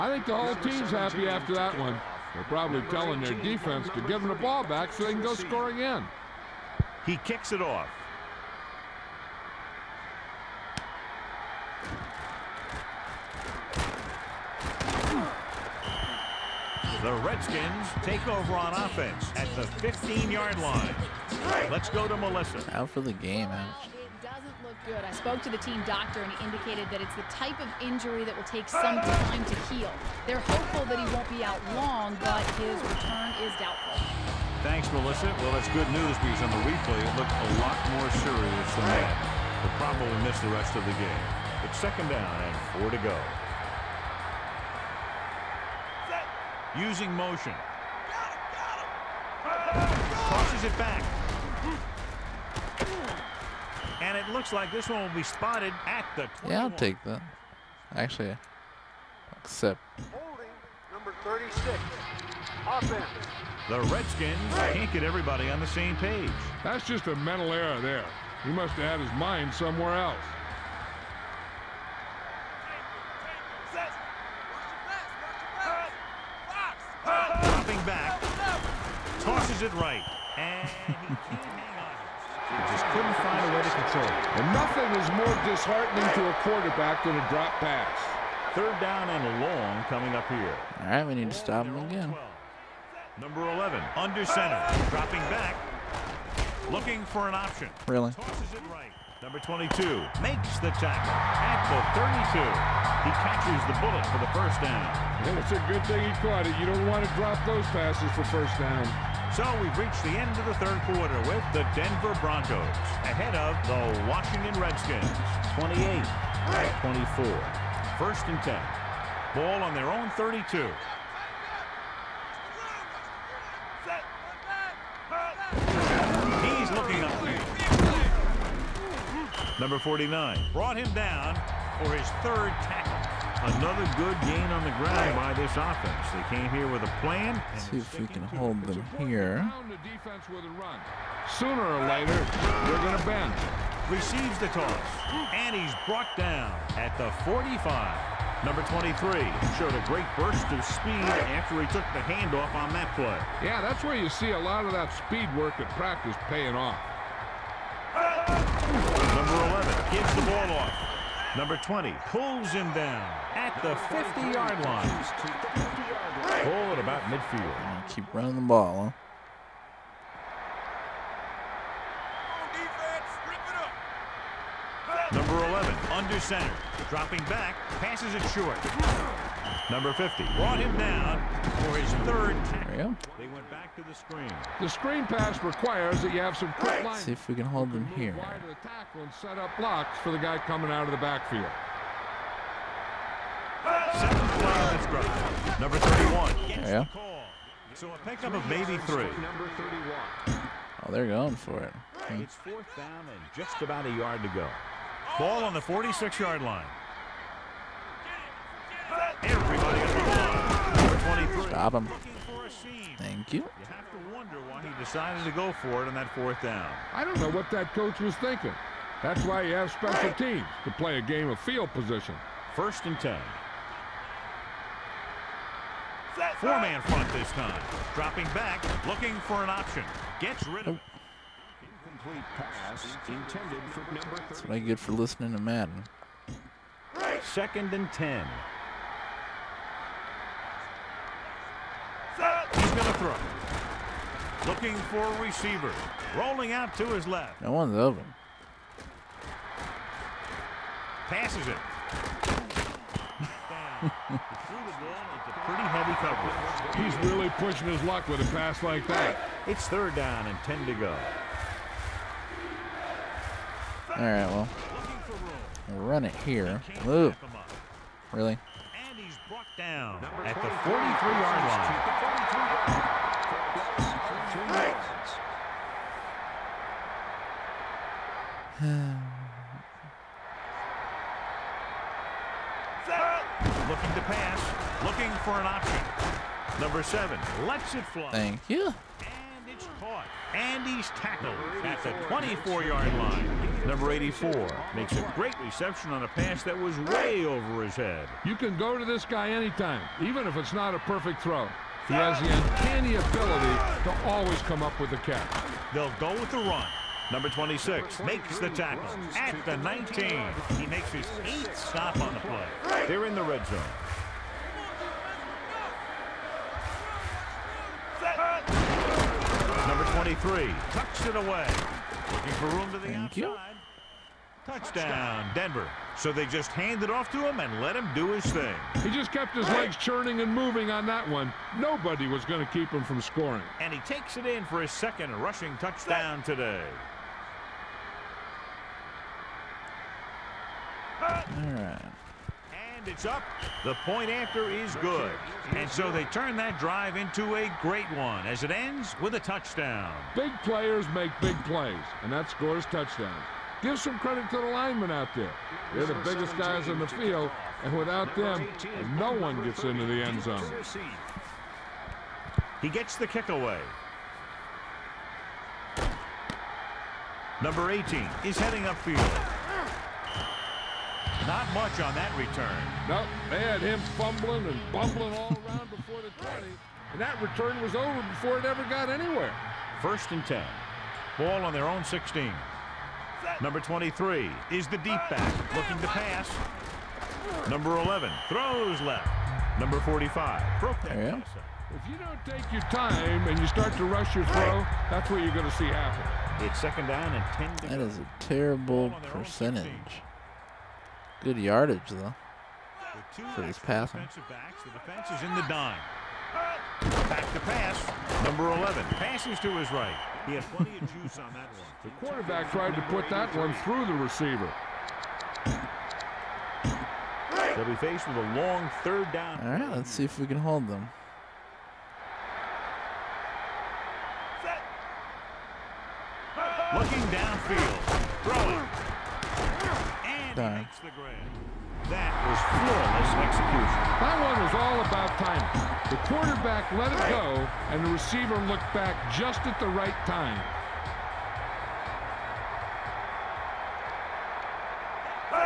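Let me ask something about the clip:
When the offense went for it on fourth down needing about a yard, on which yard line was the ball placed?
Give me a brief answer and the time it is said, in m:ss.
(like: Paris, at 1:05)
46-yard line, at 3:25.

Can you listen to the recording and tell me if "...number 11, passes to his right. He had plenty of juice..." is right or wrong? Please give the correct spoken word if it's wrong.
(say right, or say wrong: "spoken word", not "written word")
right.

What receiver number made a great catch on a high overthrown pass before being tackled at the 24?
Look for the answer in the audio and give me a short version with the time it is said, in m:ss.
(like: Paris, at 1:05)
84, at 4:53.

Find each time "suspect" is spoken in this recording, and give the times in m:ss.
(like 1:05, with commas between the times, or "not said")
not said.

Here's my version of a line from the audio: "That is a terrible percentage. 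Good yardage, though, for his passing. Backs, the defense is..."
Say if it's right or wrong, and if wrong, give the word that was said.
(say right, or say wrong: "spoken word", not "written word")
right.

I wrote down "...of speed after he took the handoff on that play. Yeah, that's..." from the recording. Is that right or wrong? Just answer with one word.
right.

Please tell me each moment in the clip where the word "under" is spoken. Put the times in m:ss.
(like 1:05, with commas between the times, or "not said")
1:33, 2:55.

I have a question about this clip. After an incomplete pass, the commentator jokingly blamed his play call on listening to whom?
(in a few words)
Madden.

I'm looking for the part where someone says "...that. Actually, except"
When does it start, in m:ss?
0:57.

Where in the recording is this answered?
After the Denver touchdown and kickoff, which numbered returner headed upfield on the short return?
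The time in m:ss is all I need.
6:07.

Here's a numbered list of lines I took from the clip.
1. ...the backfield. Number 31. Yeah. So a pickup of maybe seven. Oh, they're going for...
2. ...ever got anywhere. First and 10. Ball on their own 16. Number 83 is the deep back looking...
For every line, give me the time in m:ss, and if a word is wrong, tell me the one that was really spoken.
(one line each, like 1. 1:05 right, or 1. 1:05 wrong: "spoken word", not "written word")
1. 3:10 wrong: "three", not "seven"
2. 6:18 wrong: "23", not "83".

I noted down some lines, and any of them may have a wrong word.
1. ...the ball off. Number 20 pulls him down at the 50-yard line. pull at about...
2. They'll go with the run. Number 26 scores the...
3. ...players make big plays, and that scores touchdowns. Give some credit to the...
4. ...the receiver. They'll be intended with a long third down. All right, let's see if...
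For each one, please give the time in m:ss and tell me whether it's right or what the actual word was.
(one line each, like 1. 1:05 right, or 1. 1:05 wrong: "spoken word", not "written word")
1. 2:40 right
2. 5:05 wrong: "makes", not "scores"
3. 5:50 right
4. 6:53 wrong: "faced", not "intended".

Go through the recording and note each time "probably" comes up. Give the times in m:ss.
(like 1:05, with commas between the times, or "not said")
0:02, 0:39.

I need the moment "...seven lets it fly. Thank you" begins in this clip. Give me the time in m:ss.
4:46.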